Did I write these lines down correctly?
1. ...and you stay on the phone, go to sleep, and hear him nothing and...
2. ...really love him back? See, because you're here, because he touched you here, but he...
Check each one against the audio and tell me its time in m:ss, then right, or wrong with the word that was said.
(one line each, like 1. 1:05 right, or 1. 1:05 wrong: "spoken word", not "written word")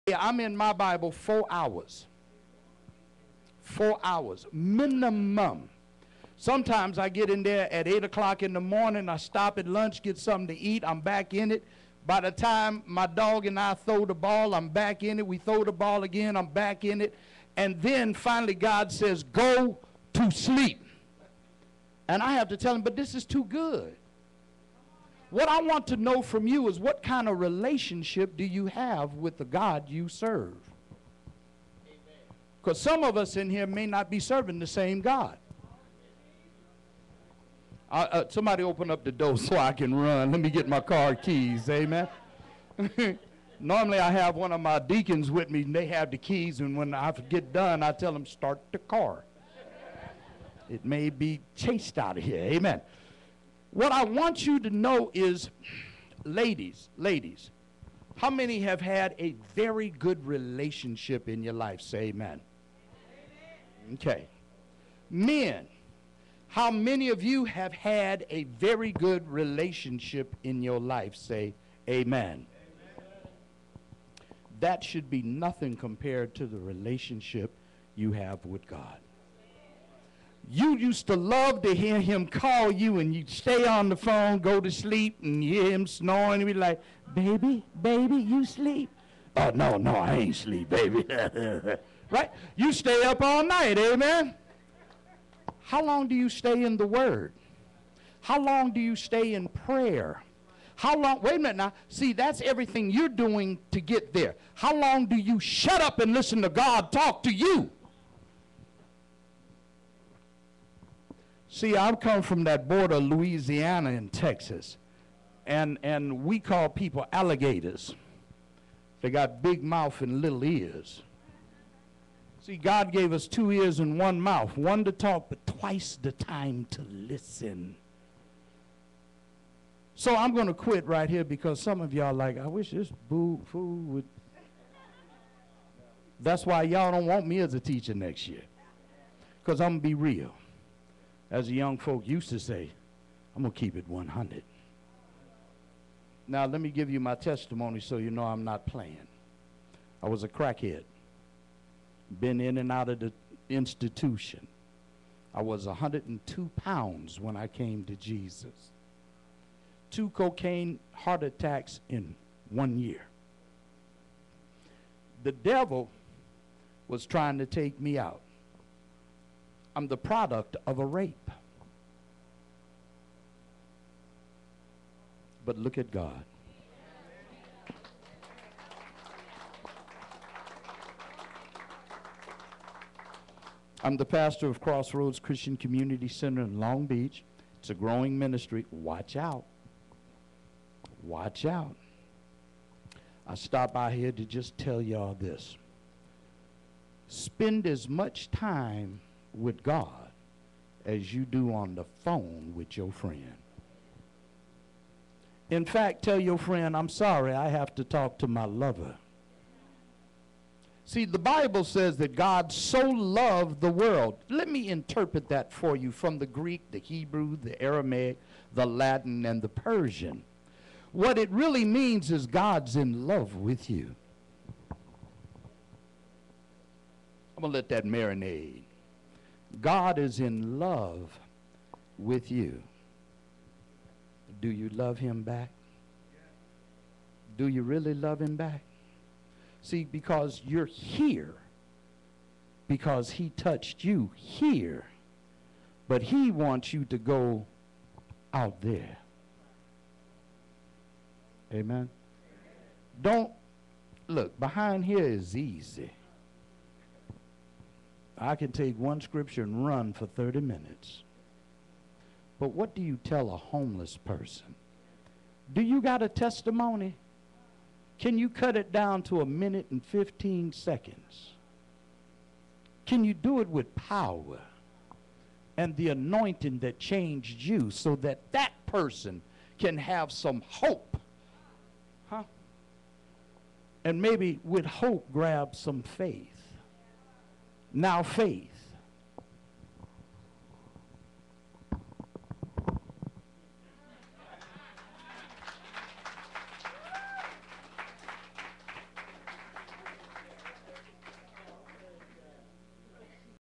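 1. 1:22 wrong: "snoring", not "nothing"
2. 3:57 right.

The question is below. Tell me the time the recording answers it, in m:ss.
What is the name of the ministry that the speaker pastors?
3:04.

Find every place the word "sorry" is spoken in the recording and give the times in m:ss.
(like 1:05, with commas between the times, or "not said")
3:26.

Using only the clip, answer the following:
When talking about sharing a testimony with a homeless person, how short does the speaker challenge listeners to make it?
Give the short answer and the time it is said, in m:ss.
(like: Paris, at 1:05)
a minute and 15 seconds, at 4:29.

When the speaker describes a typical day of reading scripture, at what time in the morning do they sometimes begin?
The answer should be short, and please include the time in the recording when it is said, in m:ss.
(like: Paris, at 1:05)
8 o'clock, at 0:07.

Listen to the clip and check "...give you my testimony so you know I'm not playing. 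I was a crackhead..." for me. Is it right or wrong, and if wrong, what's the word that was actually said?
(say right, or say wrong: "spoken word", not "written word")
right.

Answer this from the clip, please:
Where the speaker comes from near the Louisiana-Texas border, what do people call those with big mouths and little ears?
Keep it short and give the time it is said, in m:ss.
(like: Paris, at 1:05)
alligators, at 1:57.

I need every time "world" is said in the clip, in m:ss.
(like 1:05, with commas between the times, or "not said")
3:33.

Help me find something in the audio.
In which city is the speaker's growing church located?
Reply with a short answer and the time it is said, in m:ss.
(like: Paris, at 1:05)
Long Beach, at 3:06.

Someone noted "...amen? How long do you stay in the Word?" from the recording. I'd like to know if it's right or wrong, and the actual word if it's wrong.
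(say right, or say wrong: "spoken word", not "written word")
right.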